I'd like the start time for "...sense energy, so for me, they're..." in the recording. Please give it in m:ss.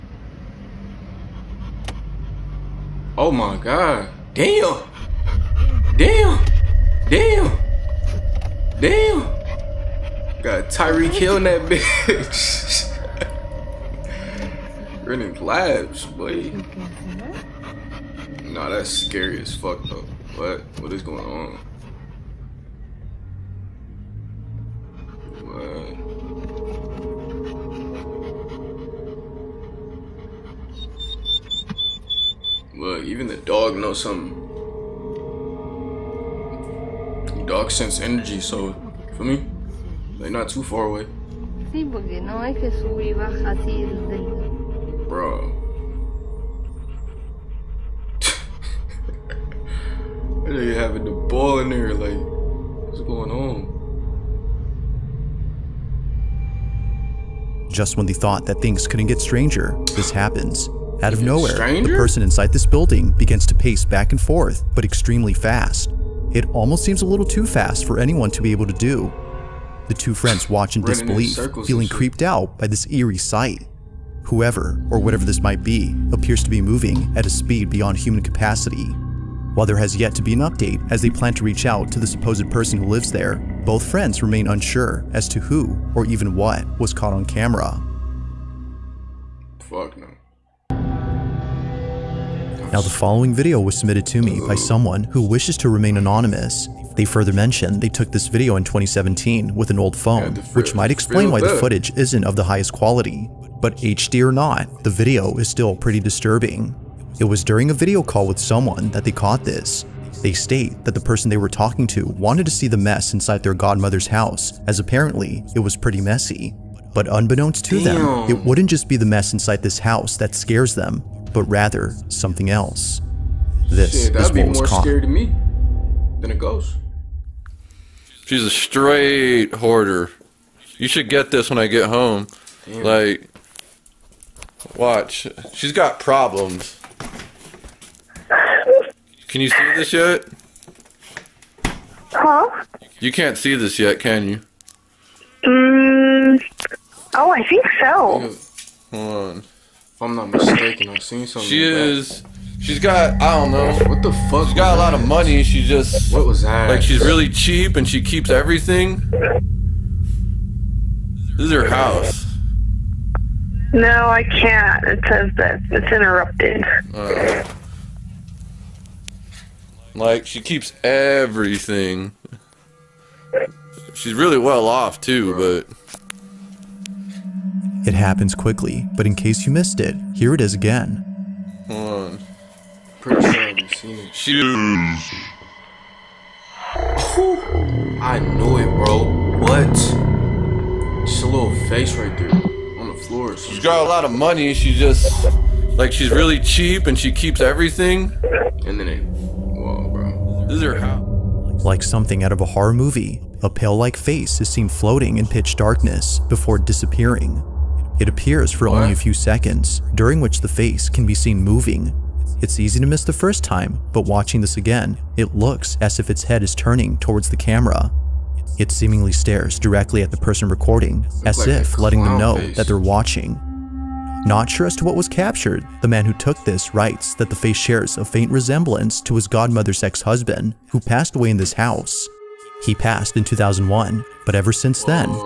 0:37.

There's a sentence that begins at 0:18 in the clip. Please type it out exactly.
Nah, that's scary as fuck though.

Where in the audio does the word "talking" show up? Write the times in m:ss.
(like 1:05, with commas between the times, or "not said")
1:51.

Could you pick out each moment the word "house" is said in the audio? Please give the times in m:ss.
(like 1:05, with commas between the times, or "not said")
1:54, 1:59, 2:41, 3:20, 3:51.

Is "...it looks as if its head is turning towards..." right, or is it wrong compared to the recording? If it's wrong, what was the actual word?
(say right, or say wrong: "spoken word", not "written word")
right.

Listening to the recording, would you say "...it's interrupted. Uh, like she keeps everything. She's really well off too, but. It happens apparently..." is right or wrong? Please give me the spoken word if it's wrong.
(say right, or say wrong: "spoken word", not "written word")
wrong: "quickly", not "apparently".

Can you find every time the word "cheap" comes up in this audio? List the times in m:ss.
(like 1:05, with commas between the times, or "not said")
2:37, 3:16.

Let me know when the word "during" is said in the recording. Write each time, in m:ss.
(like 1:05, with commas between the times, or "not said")
1:47, 3:29.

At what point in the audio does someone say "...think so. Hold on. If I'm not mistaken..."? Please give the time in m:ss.
2:27.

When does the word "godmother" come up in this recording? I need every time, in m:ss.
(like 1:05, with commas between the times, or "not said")
1:53, 3:49.